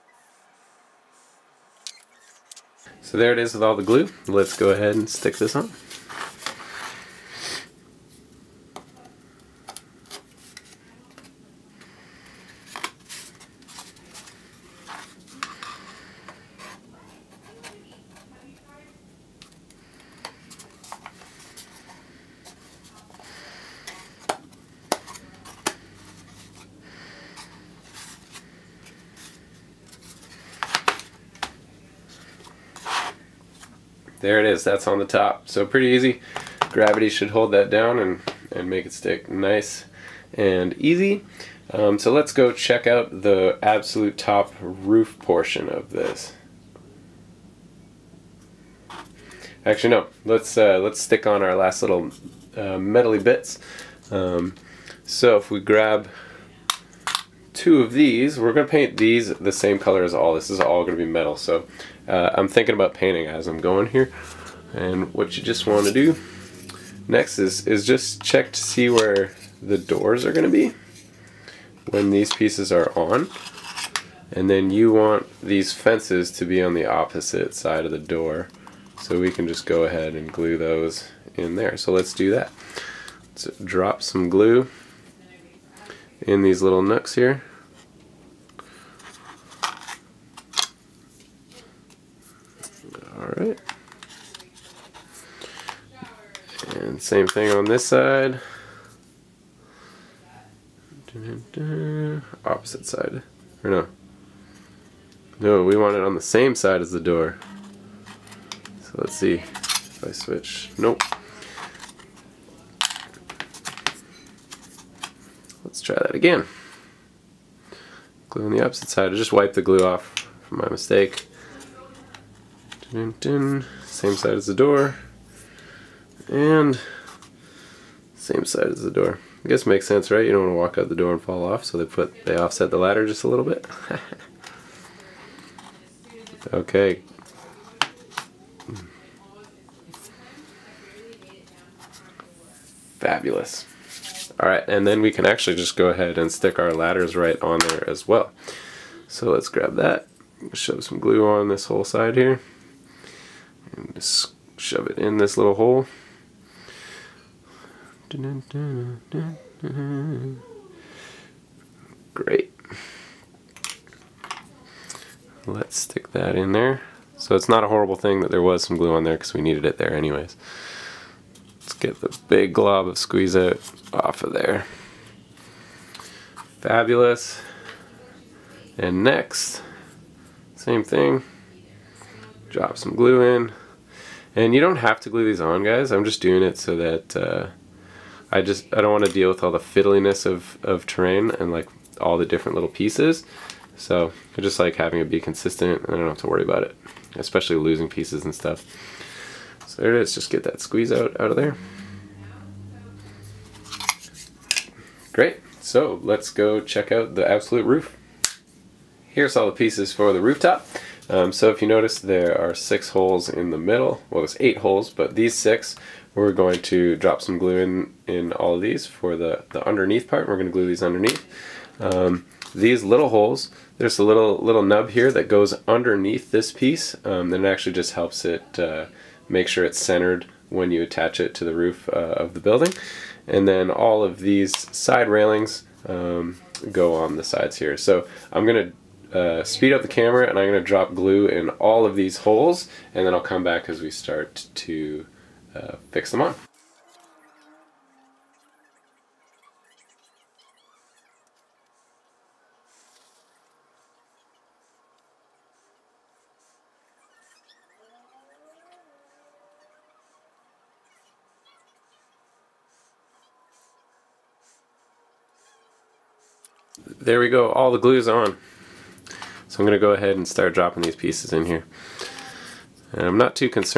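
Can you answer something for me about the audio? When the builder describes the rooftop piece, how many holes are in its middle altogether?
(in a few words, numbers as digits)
8.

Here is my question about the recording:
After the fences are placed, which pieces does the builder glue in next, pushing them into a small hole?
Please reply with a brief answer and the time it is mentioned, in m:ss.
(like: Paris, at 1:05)
Ladders, at 2:26.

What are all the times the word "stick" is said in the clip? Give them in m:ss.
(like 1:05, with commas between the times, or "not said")
0:05, 0:38, 0:50, 2:26, 2:45.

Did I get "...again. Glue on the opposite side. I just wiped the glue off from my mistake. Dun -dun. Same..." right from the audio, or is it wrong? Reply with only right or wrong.
right.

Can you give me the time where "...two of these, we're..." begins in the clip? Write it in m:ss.
0:57.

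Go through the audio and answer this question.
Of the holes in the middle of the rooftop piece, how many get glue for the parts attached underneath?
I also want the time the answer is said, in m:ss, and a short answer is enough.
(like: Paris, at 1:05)
6, at 3:35.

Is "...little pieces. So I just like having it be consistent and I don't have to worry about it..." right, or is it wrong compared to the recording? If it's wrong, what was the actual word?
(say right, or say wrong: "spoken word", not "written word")
right.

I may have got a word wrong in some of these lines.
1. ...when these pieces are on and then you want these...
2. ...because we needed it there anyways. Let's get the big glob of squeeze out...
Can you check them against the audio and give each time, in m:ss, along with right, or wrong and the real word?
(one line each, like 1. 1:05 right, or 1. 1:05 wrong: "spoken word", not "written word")
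1. 1:11 right
2. 2:49 right.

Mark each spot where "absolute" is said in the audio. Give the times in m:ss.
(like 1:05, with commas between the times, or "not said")
0:43, 3:27.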